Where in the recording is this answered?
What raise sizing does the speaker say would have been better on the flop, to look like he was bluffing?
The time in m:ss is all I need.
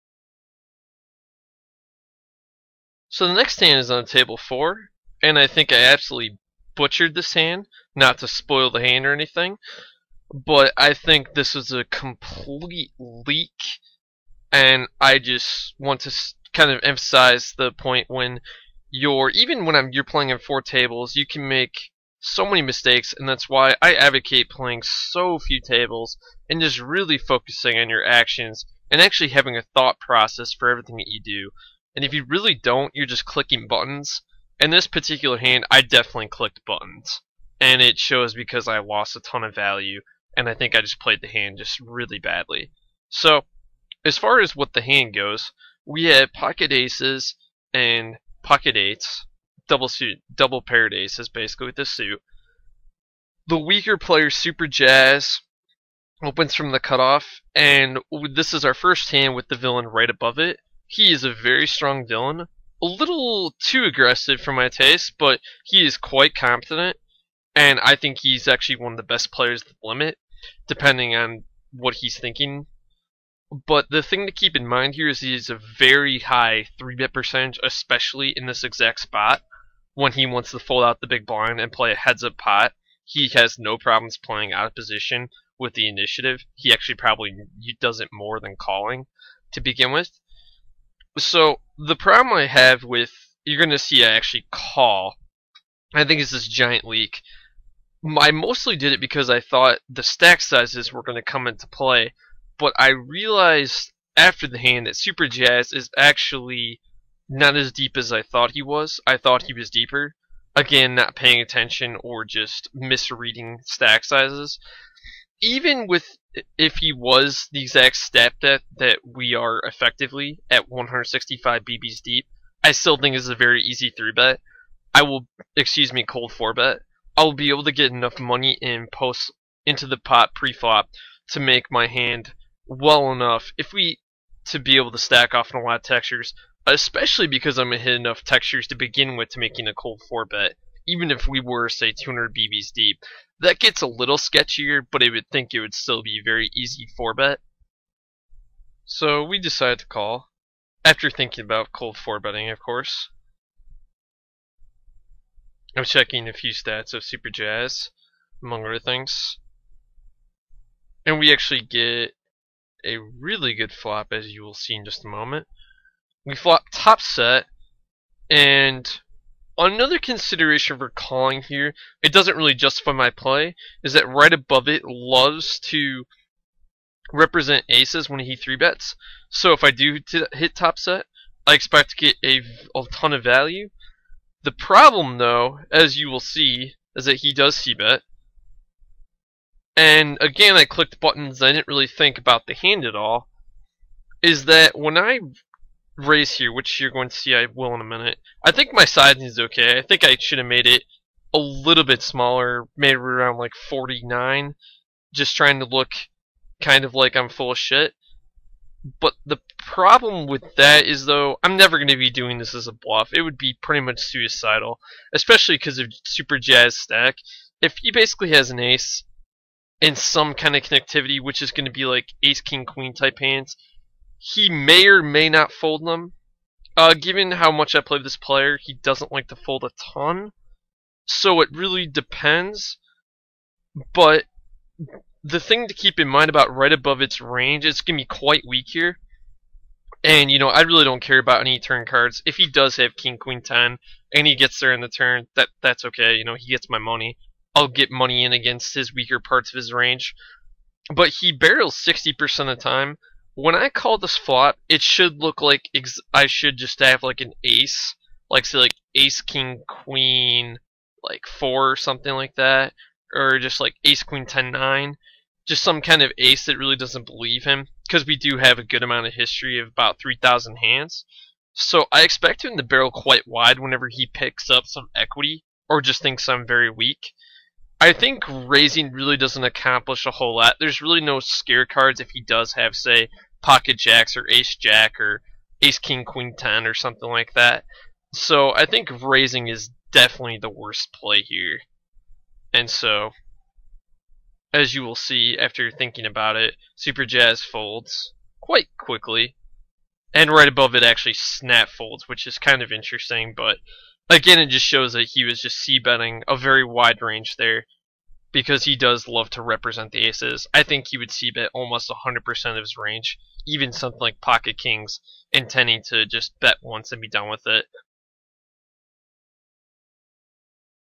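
3:23.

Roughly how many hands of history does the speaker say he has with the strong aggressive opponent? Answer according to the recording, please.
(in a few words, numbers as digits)
3000.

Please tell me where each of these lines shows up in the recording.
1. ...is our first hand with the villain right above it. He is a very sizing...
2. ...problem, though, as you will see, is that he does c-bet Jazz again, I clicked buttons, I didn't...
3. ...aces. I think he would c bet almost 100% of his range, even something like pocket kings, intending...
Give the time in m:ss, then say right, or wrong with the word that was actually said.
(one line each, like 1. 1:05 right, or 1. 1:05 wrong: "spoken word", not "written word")
1. 0:58 wrong: "strong", not "sizing"
2. 3:04 wrong: "And", not "Jazz"
3. 5:10 right.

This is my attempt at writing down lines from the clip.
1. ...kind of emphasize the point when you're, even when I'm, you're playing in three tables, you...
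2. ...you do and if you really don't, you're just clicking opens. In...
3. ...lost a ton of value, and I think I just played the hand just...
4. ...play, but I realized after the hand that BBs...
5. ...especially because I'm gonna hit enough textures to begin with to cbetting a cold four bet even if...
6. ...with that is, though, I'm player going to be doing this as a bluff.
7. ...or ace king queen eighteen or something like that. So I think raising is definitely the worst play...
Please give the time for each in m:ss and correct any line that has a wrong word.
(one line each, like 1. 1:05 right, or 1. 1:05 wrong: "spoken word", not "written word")
1. 0:16 wrong: "four", not "three"
2. 0:31 wrong: "buttons", not "opens"
3. 0:38 right
4. 1:41 wrong: "Super", not "BBs"
5. 2:16 wrong: "making", not "cbetting"
6. 3:30 wrong: "never", not "player"
7. 4:45 wrong: "ten", not "eighteen".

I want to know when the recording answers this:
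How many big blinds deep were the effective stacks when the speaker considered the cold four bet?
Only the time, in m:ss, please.
2:00.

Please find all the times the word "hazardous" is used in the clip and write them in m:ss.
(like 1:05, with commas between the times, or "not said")
not said.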